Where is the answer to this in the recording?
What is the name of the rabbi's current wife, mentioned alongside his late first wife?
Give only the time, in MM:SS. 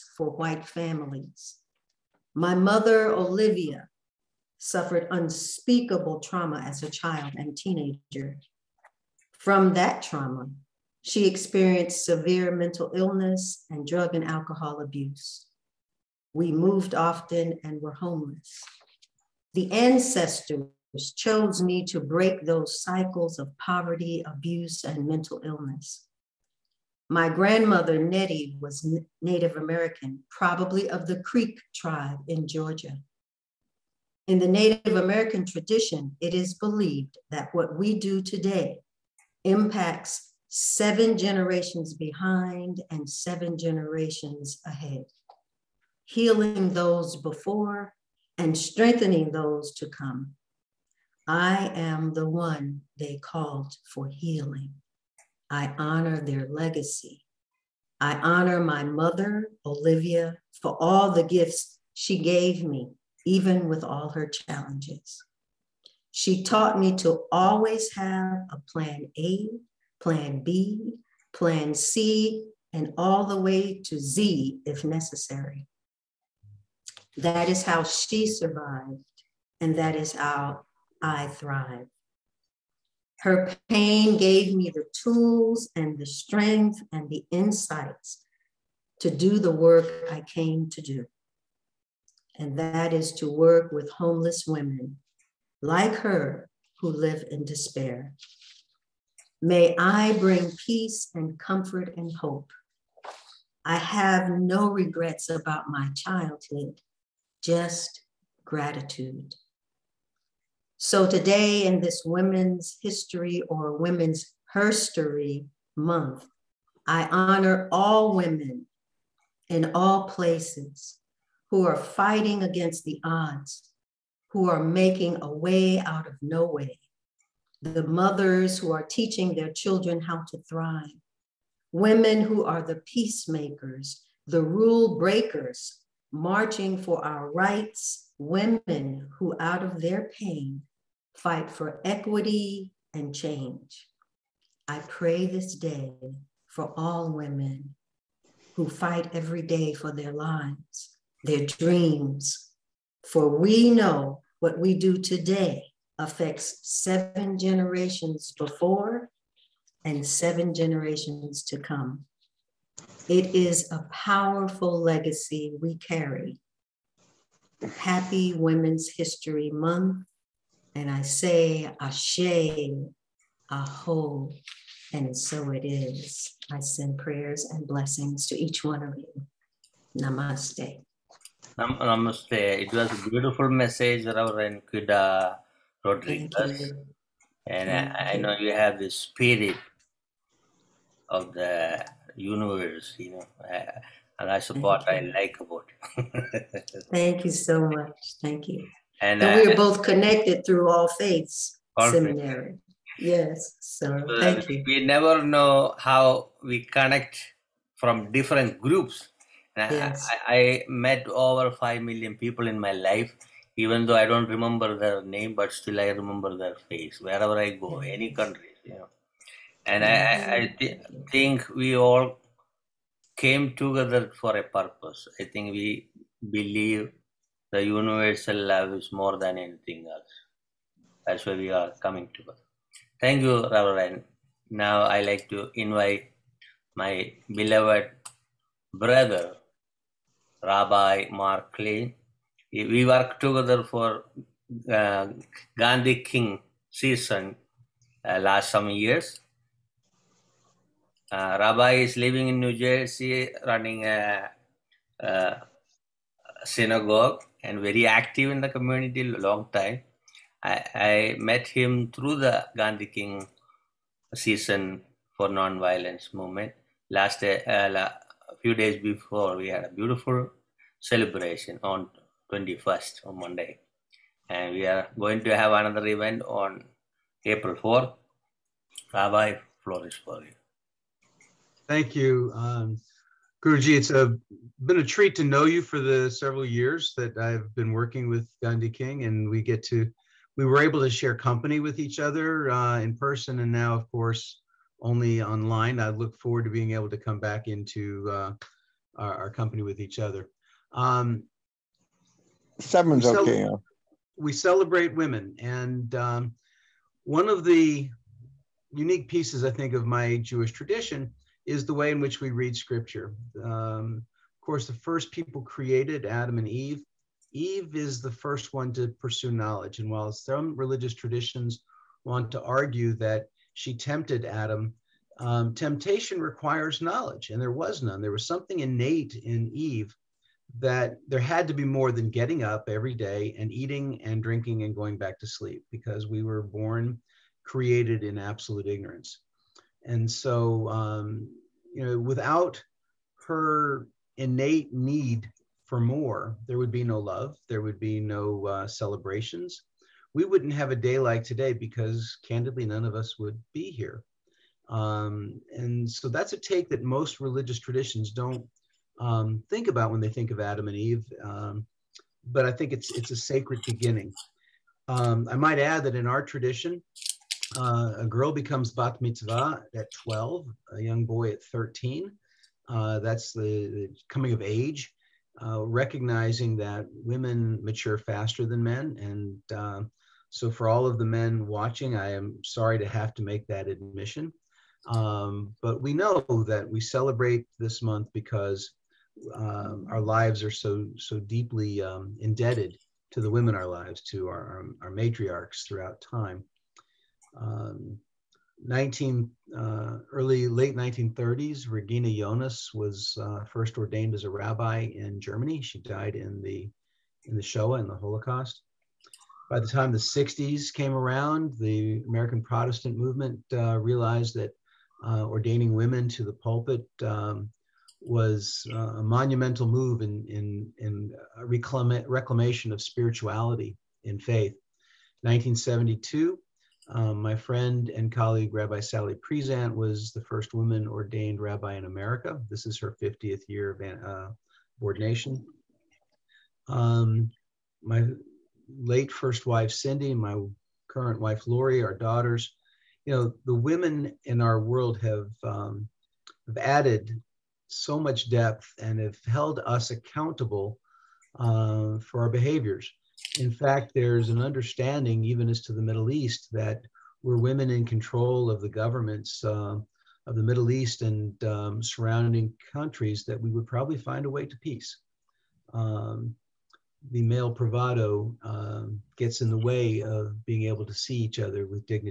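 07:21.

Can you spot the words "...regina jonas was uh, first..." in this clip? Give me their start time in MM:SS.
06:41.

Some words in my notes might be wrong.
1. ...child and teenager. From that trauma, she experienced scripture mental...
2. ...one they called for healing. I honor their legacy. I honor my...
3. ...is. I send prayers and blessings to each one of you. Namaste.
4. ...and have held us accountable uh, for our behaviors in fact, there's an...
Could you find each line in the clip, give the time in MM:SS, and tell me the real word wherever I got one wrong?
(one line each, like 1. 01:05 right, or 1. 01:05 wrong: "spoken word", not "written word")
1. 00:06 wrong: "severe", not "scripture"
2. 00:52 right
3. 02:55 right
4. 07:28 right.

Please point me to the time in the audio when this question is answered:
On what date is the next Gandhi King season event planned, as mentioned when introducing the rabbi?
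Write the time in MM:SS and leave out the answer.
04:37.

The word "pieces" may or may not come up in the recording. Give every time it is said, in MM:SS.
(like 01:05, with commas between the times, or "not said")
05:09.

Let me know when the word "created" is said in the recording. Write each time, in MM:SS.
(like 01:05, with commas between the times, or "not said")
05:15, 05:37.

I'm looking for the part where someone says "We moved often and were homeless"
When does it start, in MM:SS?
00:16.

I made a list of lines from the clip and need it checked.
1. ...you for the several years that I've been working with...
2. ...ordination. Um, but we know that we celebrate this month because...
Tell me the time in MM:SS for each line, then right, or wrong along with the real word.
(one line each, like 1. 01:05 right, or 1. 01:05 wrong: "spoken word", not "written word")
1. 04:45 right
2. 06:23 wrong: "admission", not "ordination".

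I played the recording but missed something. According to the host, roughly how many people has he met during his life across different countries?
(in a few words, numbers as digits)
5 million.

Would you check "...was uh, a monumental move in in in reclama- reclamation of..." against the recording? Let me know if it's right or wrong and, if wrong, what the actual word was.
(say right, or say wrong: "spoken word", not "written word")
right.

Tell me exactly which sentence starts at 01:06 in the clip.
She taught me to always have a plan A, plan B, plan C, and all the way to Z if necessary.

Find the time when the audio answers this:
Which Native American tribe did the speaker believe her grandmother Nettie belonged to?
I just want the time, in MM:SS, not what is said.
00:31.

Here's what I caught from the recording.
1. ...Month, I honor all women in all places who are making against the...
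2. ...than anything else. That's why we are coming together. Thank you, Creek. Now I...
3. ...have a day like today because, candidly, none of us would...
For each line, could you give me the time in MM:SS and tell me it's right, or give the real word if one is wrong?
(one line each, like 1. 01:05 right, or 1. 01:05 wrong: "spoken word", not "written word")
1. 01:55 wrong: "fighting", not "making"
2. 03:49 wrong: "Reverend", not "Creek"
3. 05:50 right.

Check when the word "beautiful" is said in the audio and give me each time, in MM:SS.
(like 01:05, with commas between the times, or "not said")
03:03, 04:29.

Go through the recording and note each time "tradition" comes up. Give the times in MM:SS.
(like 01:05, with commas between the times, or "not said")
00:35, 05:10, 05:20, 05:57, 06:06.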